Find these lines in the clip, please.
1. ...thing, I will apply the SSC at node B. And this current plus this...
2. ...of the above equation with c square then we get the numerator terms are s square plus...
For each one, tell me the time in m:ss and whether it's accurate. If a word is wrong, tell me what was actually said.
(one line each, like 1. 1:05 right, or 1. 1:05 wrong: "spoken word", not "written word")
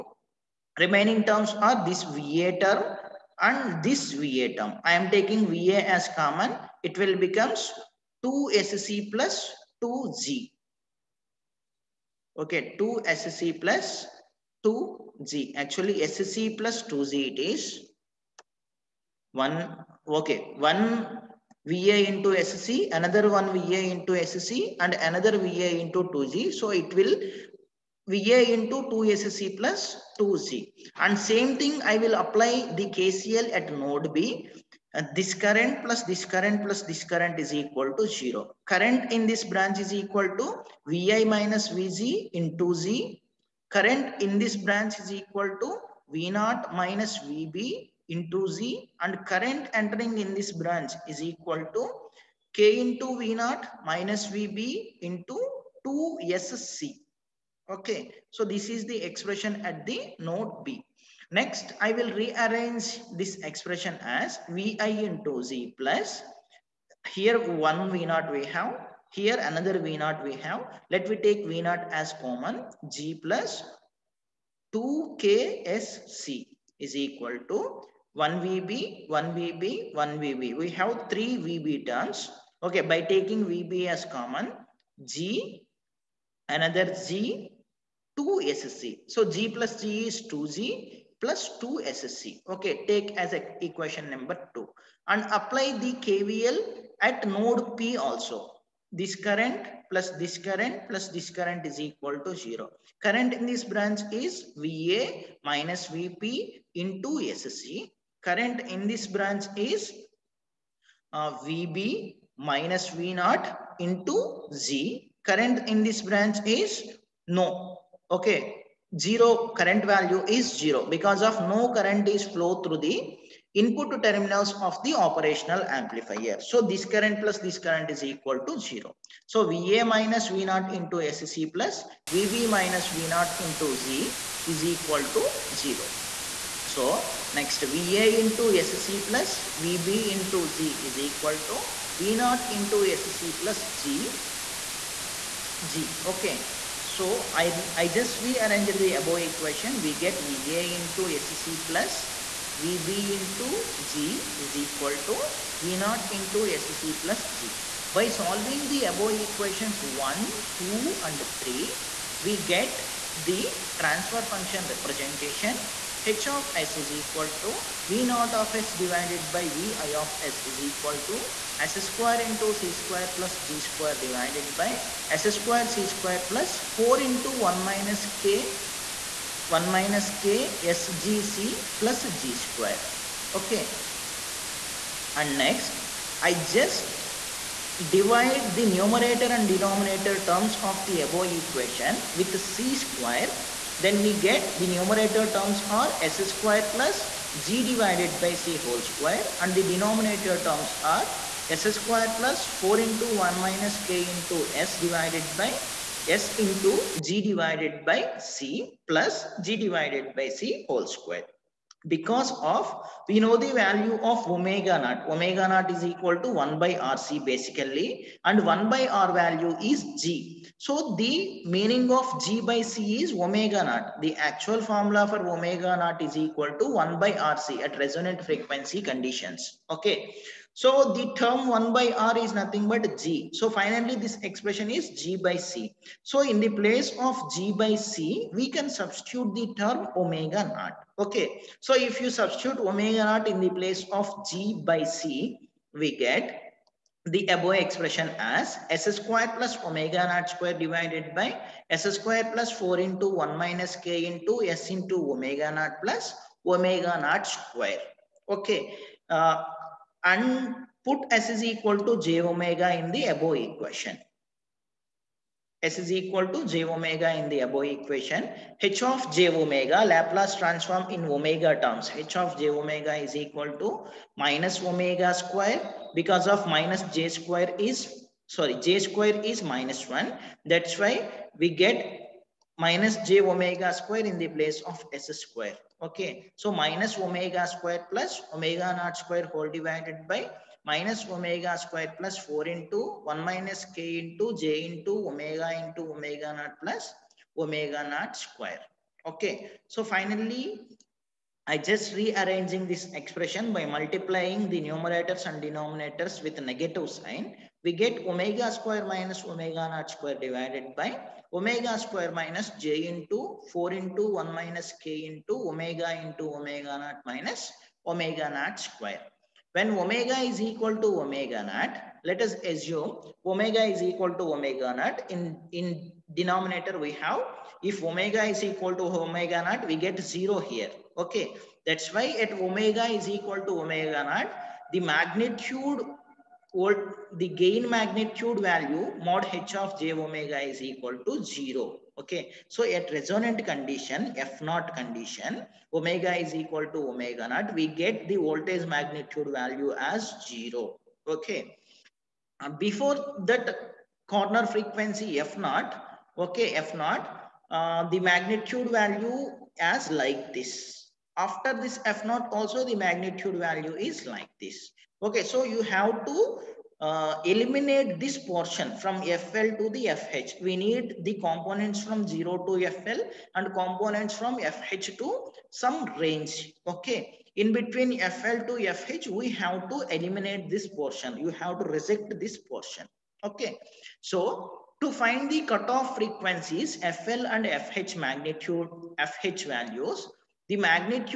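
1. 0:31 wrong: "KCL", not "SSC"
2. 3:10 right.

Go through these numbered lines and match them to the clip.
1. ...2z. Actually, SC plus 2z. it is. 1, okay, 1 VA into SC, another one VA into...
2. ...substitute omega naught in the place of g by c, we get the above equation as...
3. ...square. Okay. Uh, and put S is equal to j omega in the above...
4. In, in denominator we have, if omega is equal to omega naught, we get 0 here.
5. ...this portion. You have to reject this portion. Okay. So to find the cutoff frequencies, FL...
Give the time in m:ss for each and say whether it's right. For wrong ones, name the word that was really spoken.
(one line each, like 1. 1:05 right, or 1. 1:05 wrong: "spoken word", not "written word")
1. 0:14 right
2. 4:02 wrong: "expression", not "equation"
3. 4:17 right
4. 5:25 right
5. 6:20 right.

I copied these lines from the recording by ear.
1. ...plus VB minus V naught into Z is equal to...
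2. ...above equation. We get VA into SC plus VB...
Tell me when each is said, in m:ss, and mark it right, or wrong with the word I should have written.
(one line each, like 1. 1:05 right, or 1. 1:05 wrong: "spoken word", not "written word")
1. 2:11 right
2. 2:28 right.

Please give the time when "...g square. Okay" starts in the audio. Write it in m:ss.
3:02.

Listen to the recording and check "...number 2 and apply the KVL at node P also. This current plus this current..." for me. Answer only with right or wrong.
right.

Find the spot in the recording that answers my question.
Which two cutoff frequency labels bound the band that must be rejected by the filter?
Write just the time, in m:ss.
6:09.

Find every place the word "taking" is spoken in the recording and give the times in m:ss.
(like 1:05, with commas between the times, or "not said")
0:05, 1:23.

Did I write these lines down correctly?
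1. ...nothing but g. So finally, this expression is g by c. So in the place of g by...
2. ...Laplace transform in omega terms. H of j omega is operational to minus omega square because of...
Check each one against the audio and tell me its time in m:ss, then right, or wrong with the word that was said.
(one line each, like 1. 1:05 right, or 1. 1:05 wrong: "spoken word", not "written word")
1. 3:52 right
2. 4:29 wrong: "equal", not "operational".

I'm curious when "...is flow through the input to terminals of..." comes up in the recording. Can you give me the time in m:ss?
2:02.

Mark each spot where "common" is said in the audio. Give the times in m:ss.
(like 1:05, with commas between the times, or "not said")
0:06, 1:12, 1:24.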